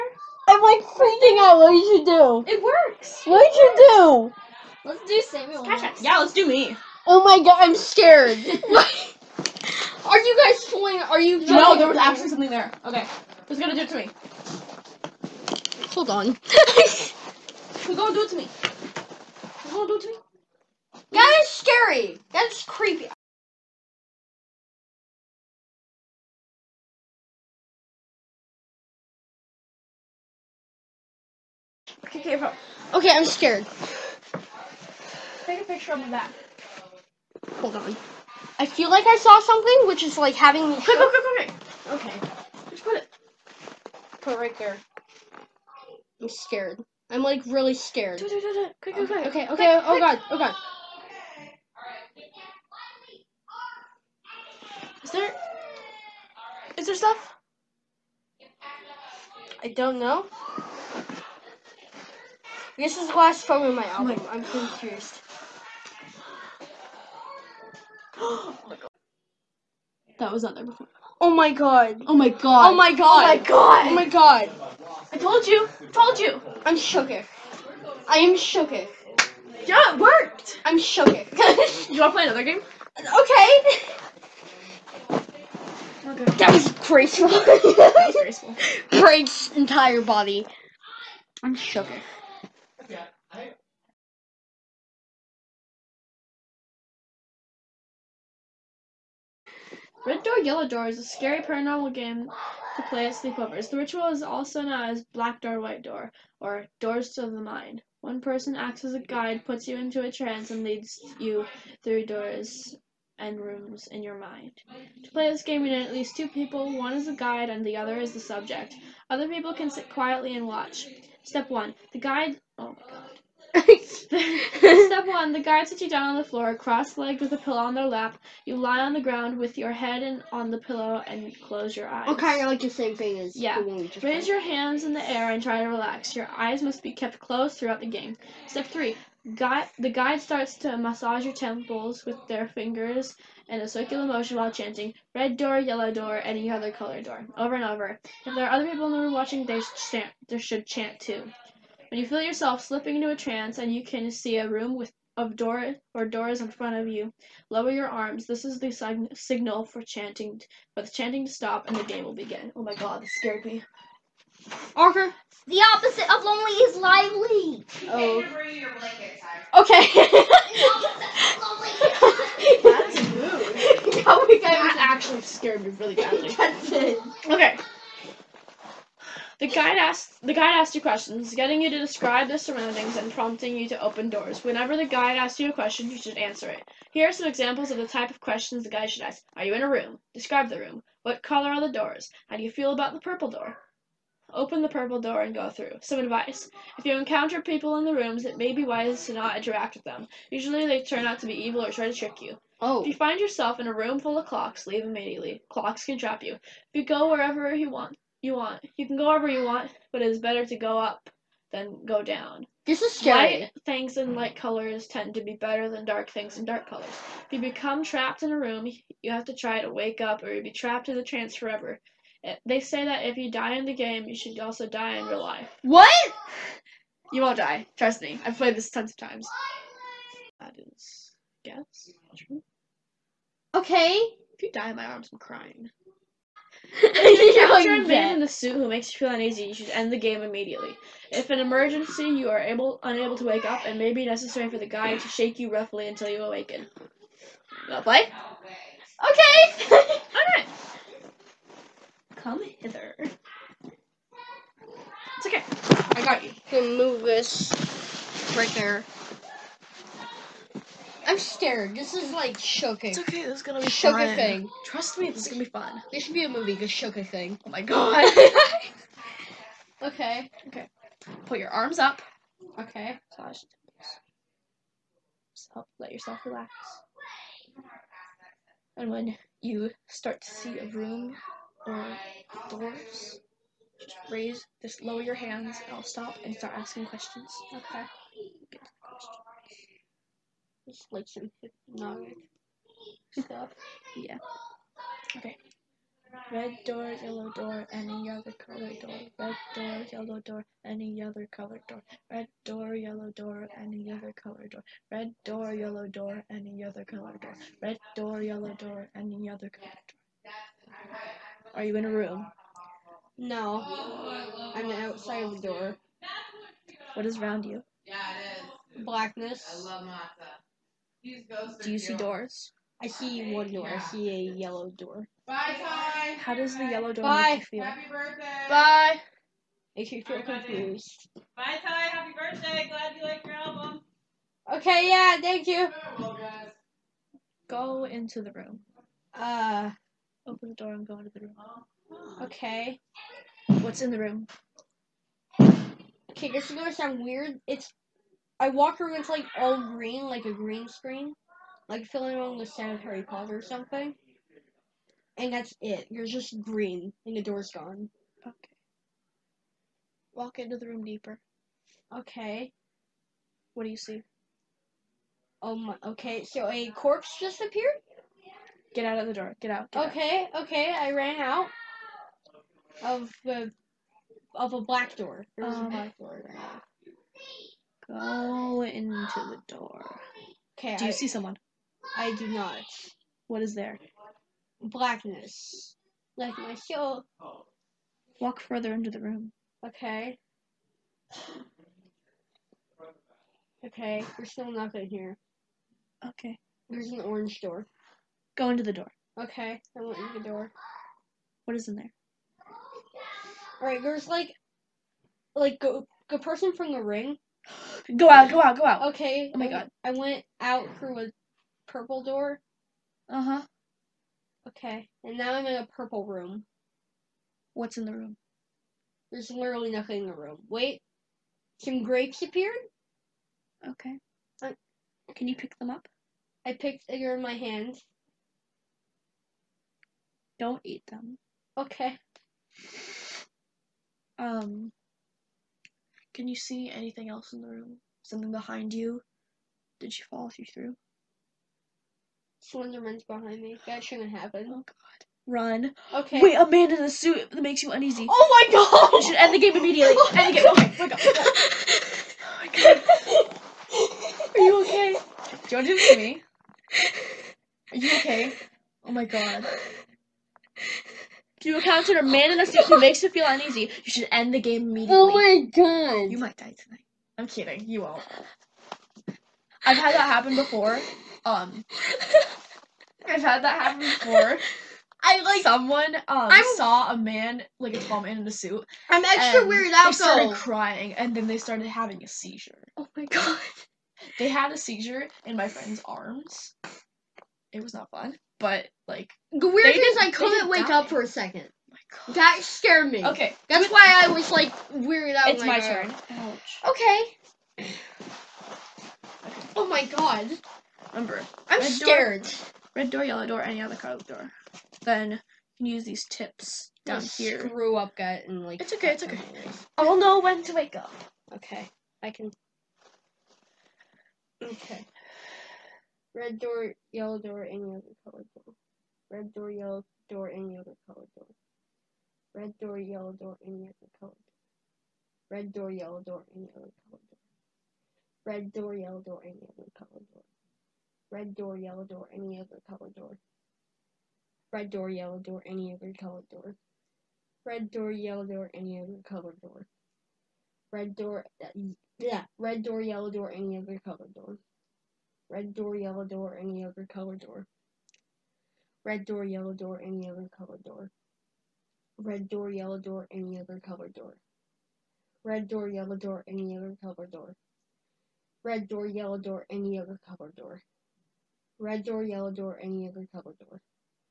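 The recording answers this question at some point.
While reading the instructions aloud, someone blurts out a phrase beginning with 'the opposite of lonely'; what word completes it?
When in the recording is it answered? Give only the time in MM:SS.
02:46.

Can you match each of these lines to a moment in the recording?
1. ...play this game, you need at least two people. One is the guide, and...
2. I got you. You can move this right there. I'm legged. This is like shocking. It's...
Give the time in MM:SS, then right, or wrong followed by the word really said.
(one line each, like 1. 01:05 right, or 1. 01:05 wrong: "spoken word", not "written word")
1. 01:55 right
2. 04:15 wrong: "scared", not "legged".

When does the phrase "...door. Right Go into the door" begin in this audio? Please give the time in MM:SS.
06:15.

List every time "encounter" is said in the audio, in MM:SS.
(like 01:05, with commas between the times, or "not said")
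03:16, 07:41.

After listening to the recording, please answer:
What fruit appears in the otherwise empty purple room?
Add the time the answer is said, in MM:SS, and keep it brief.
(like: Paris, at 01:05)
Grapes, at 07:01.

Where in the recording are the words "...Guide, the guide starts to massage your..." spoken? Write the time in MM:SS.
02:19.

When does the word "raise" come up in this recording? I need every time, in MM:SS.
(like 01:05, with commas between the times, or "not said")
02:14, 04:44.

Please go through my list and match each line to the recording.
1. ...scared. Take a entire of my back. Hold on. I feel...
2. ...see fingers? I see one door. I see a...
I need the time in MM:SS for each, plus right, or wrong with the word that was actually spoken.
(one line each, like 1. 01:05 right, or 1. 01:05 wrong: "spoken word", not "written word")
1. 00:33 wrong: "picture", not "entire"
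2. 05:21 wrong: "doors", not "fingers".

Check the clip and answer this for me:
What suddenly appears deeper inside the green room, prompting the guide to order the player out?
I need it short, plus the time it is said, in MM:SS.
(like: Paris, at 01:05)
A corpse, at 06:06.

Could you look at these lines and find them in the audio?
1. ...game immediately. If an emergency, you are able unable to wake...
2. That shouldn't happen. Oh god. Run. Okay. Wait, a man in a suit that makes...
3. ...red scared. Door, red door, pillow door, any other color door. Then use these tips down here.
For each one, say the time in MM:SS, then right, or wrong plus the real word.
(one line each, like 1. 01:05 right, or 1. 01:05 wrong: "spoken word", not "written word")
1. 03:59 right
2. 07:23 right
3. 08:21 wrong: "yellow", not "pillow".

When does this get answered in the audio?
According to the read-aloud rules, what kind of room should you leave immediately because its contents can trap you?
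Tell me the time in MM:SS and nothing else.
03:23.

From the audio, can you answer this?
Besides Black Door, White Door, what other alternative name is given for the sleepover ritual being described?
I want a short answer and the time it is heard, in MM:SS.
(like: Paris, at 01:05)
Doors to the Mind, at 01:46.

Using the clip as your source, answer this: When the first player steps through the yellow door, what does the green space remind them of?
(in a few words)
A green screen.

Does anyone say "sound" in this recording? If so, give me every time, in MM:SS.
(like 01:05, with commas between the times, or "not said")
05:46, 05:52.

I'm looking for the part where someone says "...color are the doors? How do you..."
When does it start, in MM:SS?
03:11.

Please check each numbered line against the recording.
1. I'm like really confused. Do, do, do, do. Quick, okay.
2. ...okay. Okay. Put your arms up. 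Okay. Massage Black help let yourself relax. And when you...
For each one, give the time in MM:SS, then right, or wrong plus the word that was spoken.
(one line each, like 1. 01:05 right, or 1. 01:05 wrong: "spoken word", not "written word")
1. 00:47 wrong: "scared", not "confused"
2. 04:29 wrong: "Just", not "Black".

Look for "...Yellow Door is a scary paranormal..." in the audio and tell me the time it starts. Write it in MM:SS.
01:40.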